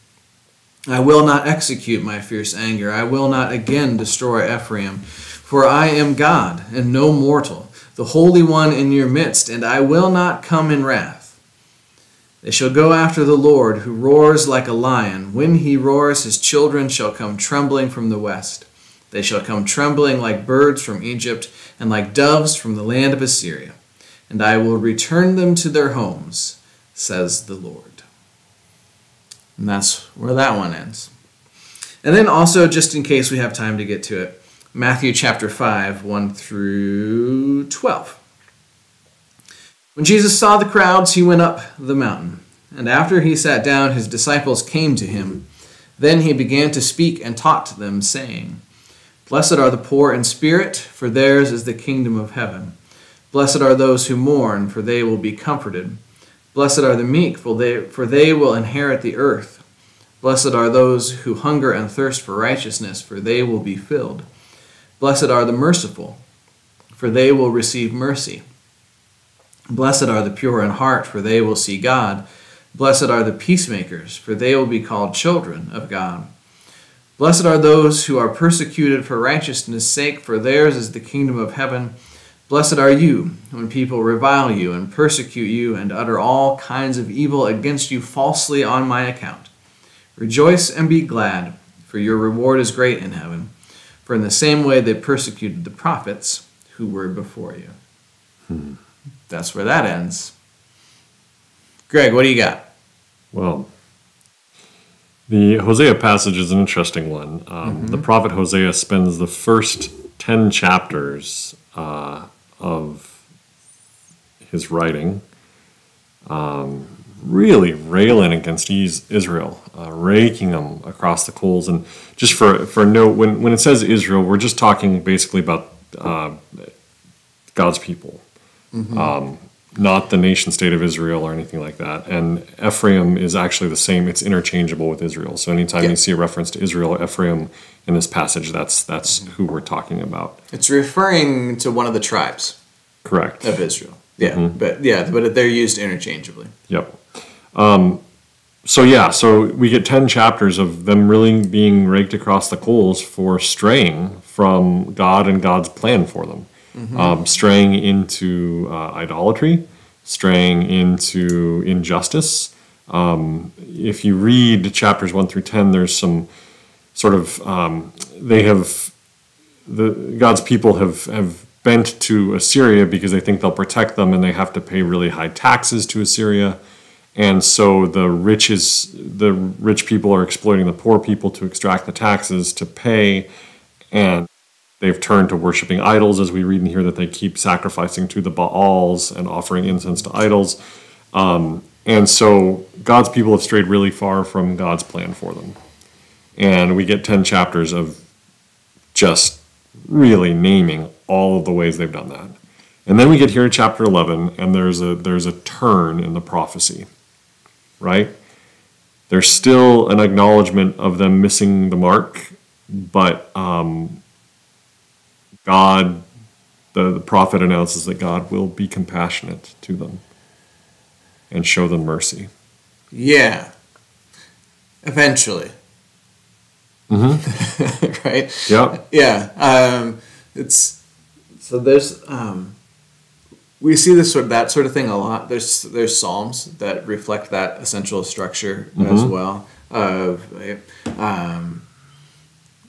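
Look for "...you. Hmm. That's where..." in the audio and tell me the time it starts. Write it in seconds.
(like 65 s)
97 s.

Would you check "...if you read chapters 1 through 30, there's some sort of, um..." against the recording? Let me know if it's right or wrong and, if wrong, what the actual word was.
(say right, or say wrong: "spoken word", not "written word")
wrong: "10", not "30".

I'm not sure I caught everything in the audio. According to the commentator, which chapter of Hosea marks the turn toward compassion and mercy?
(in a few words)
Chapter 11.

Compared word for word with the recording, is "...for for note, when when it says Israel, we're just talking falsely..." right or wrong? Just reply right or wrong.
wrong.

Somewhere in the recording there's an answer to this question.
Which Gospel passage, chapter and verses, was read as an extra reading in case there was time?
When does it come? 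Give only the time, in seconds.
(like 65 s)
34 s.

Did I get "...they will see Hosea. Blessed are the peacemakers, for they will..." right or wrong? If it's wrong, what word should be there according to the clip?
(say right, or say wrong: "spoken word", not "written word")
wrong: "God", not "Hosea".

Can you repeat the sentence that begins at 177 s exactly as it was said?
And so the rich is, the rich people are exploiting the poor people to extract the taxes to pay.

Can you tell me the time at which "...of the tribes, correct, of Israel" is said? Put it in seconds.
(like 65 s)
141 s.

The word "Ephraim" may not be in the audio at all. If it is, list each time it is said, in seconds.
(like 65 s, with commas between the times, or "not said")
4 s, 132 s, 137 s.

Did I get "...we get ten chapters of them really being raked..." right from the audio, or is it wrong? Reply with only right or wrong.
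right.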